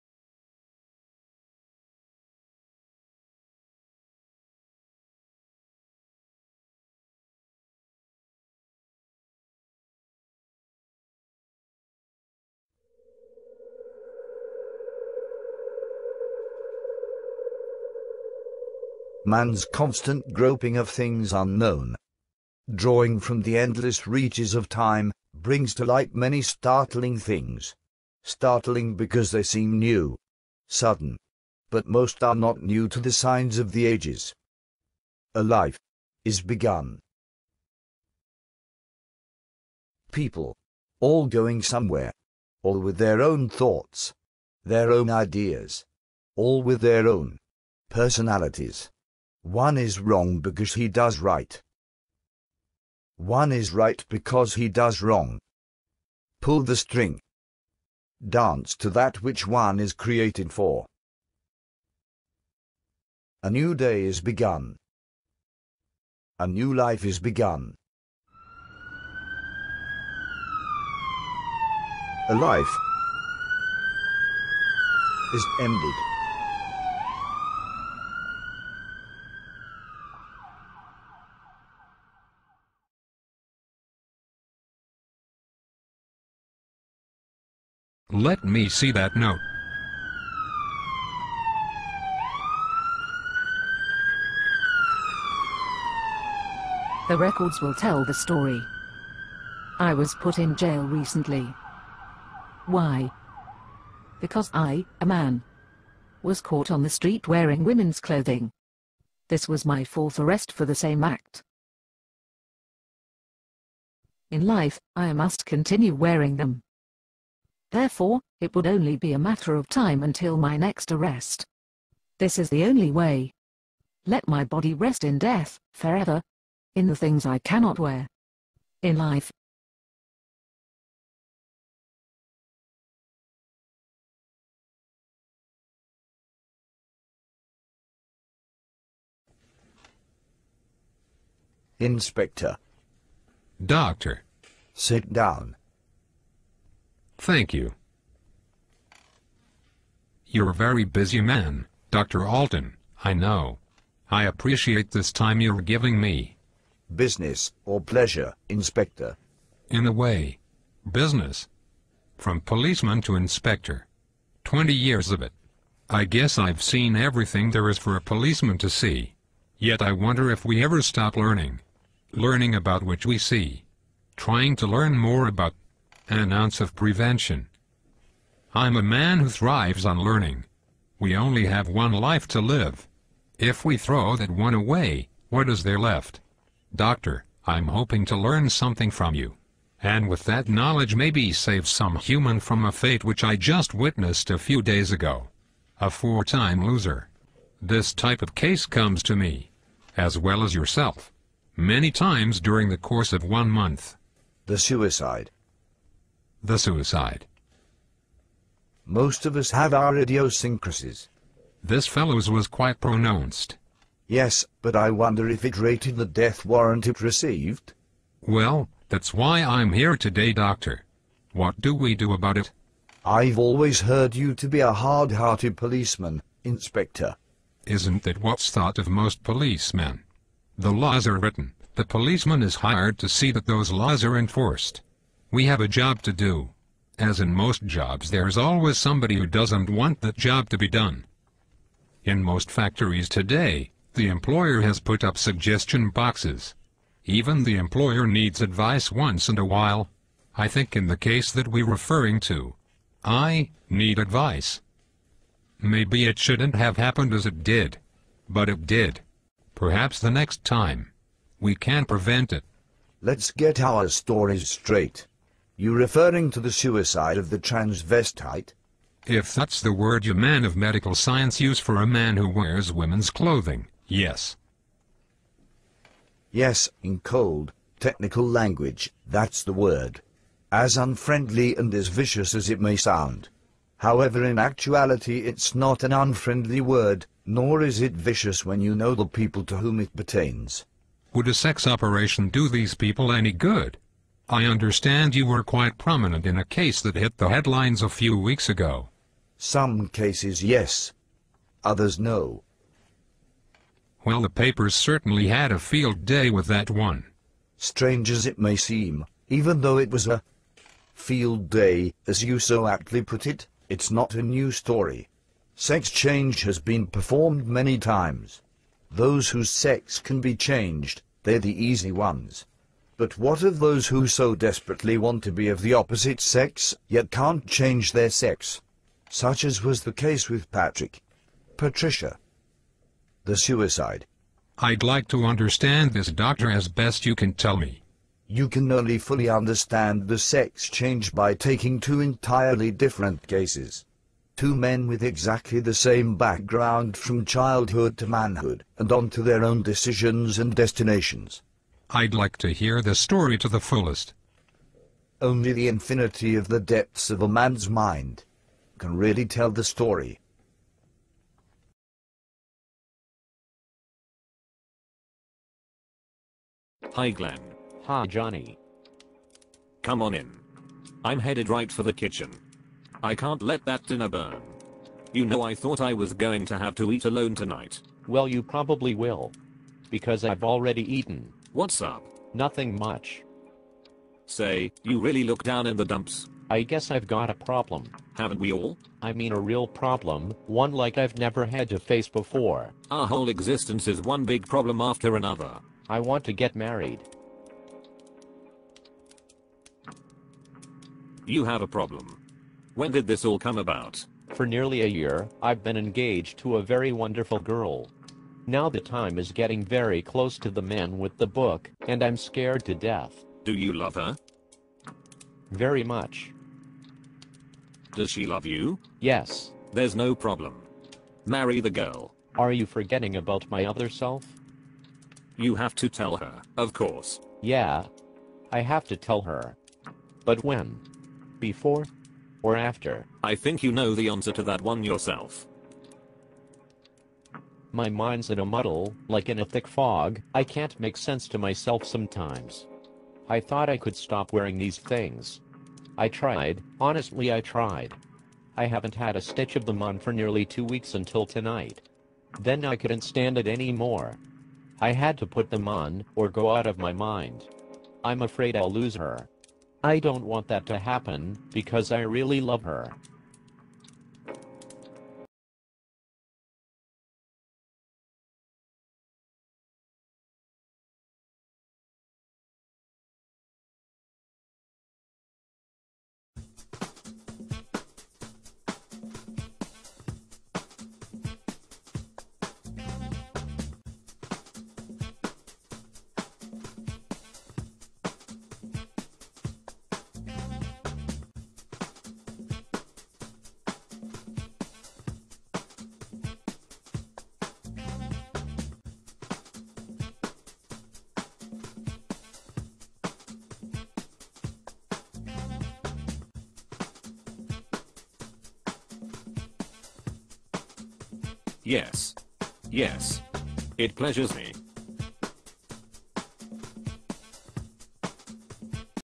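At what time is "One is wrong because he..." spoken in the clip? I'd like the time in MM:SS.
00:49.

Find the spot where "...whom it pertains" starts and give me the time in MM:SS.
04:49.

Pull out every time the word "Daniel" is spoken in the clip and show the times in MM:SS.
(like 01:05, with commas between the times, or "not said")
not said.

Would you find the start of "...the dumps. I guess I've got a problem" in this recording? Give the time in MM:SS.
06:25.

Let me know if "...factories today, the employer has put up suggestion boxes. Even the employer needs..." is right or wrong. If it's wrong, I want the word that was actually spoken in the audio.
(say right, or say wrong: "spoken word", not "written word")
right.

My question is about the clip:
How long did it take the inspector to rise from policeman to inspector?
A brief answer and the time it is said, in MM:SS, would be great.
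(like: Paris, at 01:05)
20 years, at 02:44.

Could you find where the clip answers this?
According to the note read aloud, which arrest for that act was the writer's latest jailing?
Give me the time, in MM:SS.
01:49.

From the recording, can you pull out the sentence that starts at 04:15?
Maybe it shouldn't have happened as it did.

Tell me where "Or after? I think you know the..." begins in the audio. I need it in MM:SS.
07:12.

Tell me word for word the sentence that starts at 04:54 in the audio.
I understand you were quite prominent in a case that hit the headlines a few weeks ago.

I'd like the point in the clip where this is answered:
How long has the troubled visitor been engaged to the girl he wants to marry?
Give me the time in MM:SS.
06:44.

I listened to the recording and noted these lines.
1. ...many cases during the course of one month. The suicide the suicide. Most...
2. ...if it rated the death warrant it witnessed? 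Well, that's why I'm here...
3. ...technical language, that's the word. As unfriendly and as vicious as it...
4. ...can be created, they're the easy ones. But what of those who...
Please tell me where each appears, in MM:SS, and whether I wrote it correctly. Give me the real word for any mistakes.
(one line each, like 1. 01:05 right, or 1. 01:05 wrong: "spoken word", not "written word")
1. 03:21 wrong: "times", not "cases"
2. 03:35 wrong: "received", not "witnessed"
3. 04:37 right
4. 05:19 wrong: "changed", not "created".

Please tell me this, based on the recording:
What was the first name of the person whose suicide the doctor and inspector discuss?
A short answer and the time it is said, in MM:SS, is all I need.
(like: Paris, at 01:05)
Patrick, at 05:30.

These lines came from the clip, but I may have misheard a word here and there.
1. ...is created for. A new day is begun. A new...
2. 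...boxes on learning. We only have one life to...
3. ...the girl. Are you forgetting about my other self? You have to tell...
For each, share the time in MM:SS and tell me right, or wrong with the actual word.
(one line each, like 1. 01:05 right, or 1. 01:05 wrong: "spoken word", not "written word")
1. 00:59 right
2. 02:59 wrong: "thrives", not "boxes"
3. 07:01 right.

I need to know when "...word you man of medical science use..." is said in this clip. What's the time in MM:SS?
04:29.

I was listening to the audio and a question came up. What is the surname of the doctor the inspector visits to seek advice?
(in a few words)
Alton.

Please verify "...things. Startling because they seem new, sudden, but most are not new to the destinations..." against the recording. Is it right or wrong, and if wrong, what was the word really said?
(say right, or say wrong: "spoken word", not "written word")
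wrong: "signs", not "destinations".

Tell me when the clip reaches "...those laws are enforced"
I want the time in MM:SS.
03:53.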